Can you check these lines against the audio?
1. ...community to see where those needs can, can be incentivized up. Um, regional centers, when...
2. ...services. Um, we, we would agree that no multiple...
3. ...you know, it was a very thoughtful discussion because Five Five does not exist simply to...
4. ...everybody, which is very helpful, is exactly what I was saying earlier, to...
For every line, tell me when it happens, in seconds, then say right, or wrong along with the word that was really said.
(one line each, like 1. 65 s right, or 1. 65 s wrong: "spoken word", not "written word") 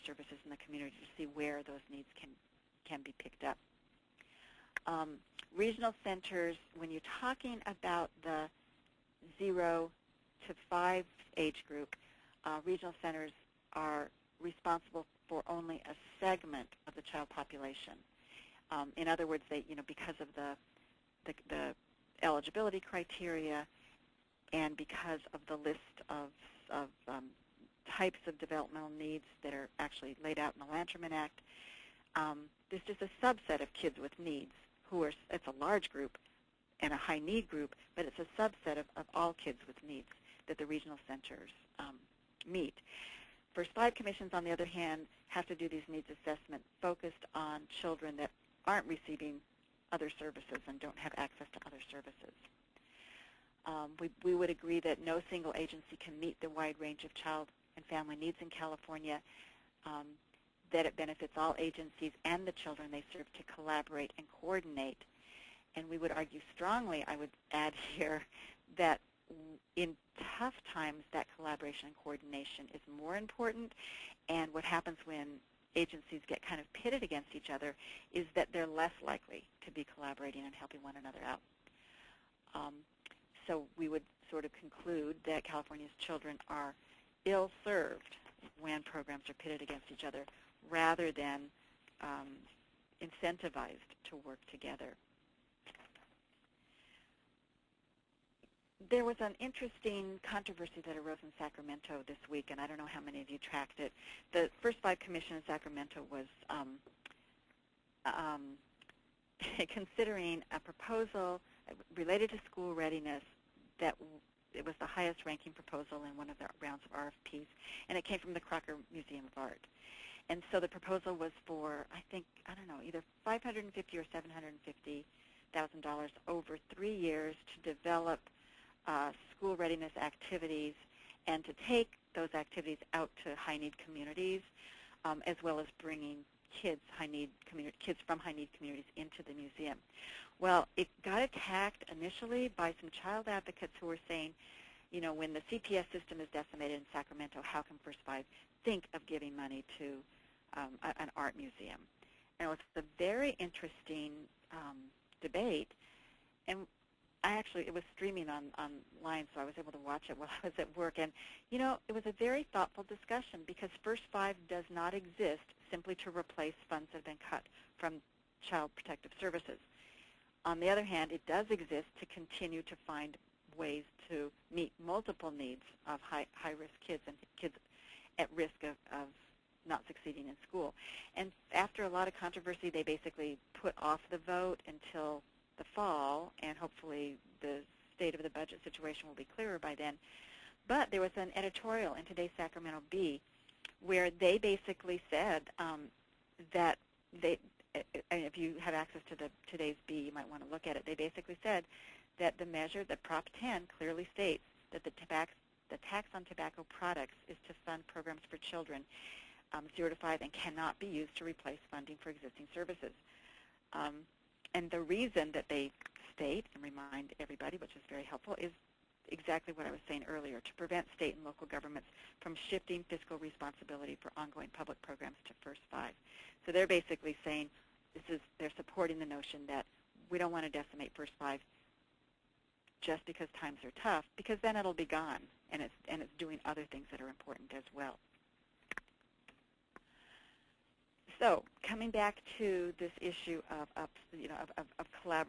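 1. 0 s wrong: "picked", not "incentivized"
2. 51 s wrong: "single", not "multiple"
3. 161 s wrong: "First", not "Five"
4. 217 s right.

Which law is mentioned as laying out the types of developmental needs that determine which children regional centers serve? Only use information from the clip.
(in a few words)
Lanterman Act.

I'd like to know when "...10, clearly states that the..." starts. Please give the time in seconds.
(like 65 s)
203 s.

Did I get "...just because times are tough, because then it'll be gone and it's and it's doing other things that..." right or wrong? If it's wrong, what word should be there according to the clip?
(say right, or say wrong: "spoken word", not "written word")
right.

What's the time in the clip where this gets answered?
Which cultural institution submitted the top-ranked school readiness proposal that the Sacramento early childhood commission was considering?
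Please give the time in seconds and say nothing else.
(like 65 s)
118 s.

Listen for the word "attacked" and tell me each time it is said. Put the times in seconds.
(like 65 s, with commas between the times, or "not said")
141 s.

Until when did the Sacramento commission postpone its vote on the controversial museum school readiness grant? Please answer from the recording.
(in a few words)
the fall.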